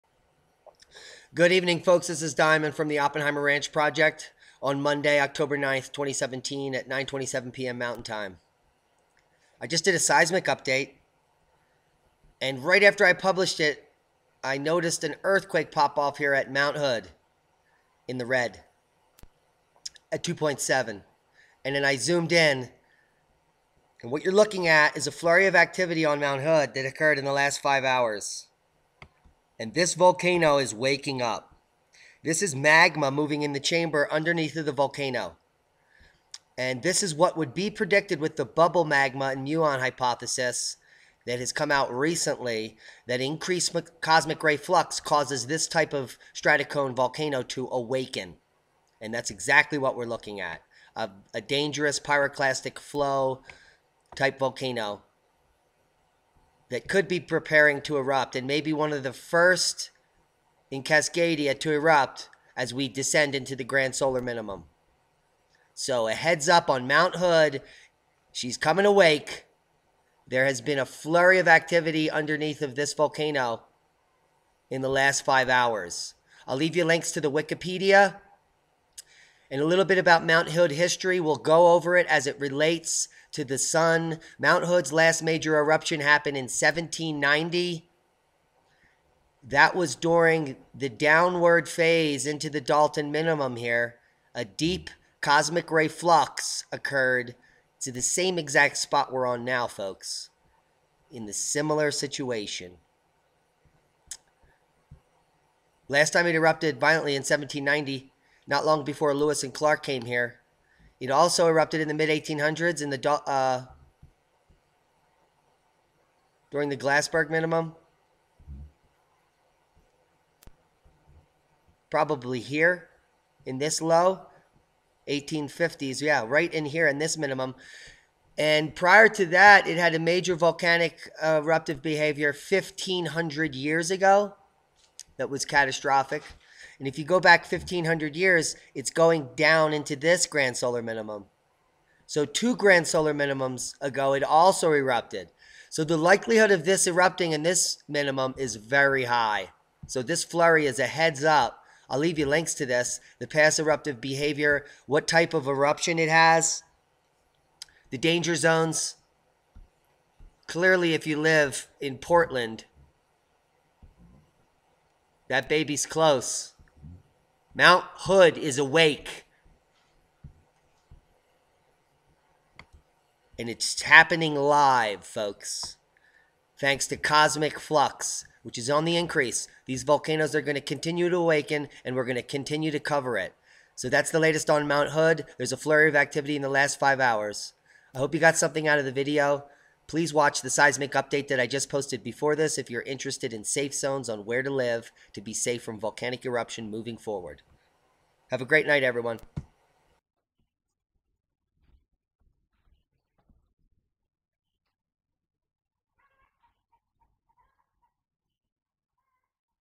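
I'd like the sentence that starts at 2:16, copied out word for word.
And if you go back 1500 years, it's going down into this grand solar minimum.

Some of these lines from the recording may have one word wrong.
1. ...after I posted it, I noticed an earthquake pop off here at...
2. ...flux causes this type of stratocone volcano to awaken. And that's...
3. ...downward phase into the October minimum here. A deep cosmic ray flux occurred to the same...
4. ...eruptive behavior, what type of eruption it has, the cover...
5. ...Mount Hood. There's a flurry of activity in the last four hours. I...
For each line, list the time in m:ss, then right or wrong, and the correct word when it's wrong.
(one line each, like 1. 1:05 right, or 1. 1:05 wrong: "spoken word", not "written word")
1. 0:12 wrong: "published", not "posted"
2. 0:44 right
3. 1:30 wrong: "Dalton", not "October"
4. 2:33 wrong: "danger", not "cover"
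5. 3:04 wrong: "five", not "four".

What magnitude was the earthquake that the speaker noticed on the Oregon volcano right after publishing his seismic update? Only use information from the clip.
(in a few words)
2.7.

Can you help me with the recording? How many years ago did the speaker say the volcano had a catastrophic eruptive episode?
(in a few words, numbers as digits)
1500.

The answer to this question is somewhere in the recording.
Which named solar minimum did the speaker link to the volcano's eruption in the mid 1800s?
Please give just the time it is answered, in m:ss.
1:56.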